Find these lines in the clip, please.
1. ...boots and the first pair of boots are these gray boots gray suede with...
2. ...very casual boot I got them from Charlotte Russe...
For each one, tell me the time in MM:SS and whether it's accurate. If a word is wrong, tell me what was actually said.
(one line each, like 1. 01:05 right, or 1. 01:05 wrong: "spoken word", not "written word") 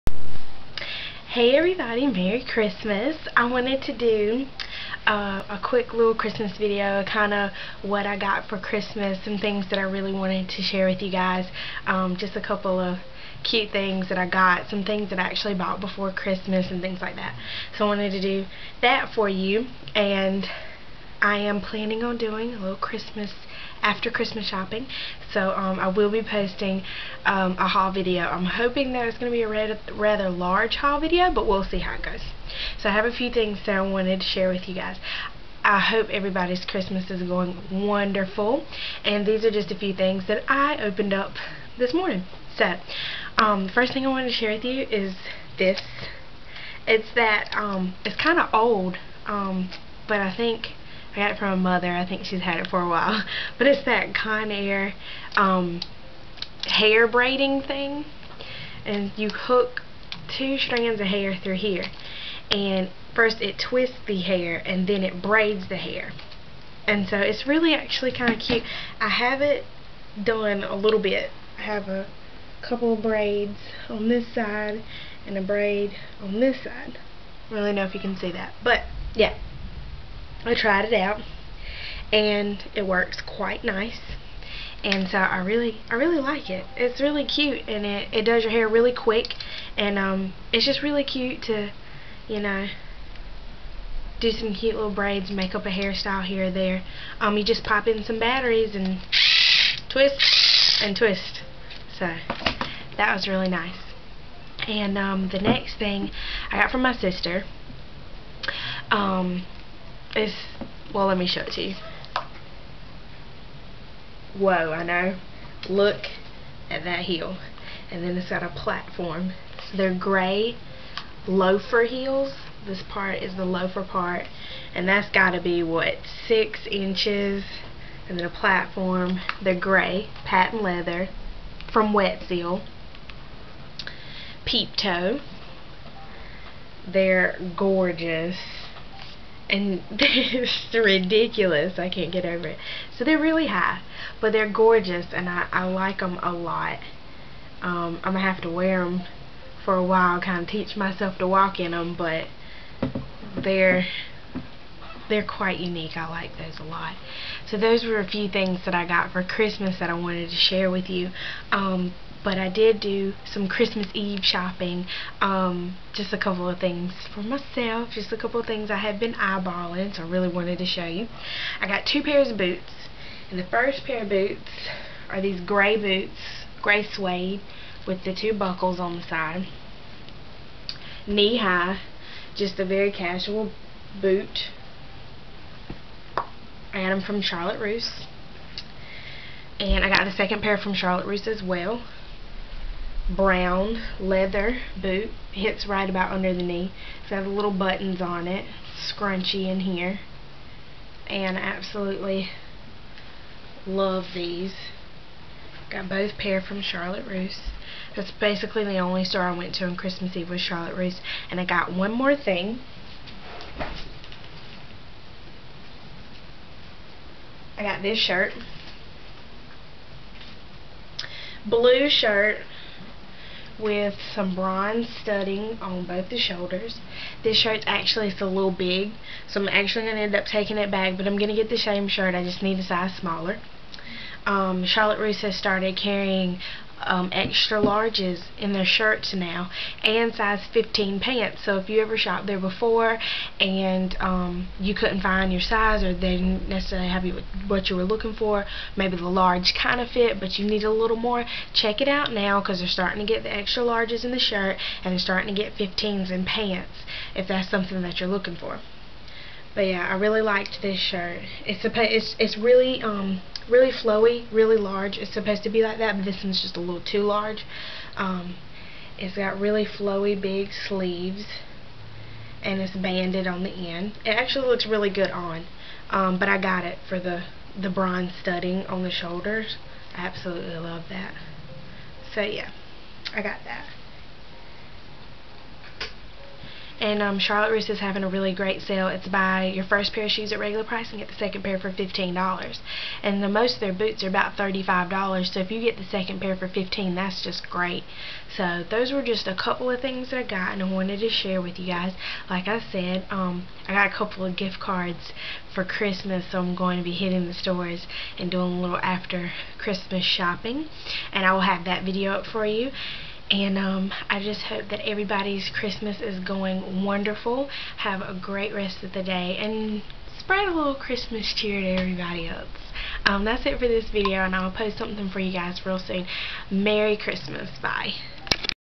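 1. 02:52 right
2. 03:02 right.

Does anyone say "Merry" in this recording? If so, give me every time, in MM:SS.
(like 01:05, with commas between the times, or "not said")
00:02, 05:26.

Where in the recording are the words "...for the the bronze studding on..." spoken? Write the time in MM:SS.
04:36.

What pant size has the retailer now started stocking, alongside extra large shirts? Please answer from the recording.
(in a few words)
15.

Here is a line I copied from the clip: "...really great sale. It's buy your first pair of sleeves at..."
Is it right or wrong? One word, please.
wrong.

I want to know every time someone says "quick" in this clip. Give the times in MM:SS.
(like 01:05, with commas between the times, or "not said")
00:05, 01:28.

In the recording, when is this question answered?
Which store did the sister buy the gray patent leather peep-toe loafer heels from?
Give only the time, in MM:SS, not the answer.
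02:11.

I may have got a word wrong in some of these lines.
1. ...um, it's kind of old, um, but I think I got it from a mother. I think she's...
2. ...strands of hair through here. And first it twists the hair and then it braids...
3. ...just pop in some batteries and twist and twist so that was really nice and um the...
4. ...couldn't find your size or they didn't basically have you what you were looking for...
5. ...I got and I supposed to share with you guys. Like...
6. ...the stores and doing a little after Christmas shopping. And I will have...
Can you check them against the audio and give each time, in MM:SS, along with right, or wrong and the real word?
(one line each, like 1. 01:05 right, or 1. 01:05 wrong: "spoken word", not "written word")
1. 00:47 right
2. 01:00 right
3. 01:37 right
4. 04:04 wrong: "necessarily", not "basically"
5. 05:00 wrong: "wanted", not "supposed"
6. 05:07 right.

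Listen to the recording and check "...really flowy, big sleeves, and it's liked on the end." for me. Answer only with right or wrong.
wrong.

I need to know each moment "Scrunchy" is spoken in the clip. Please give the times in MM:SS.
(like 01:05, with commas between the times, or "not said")
03:18.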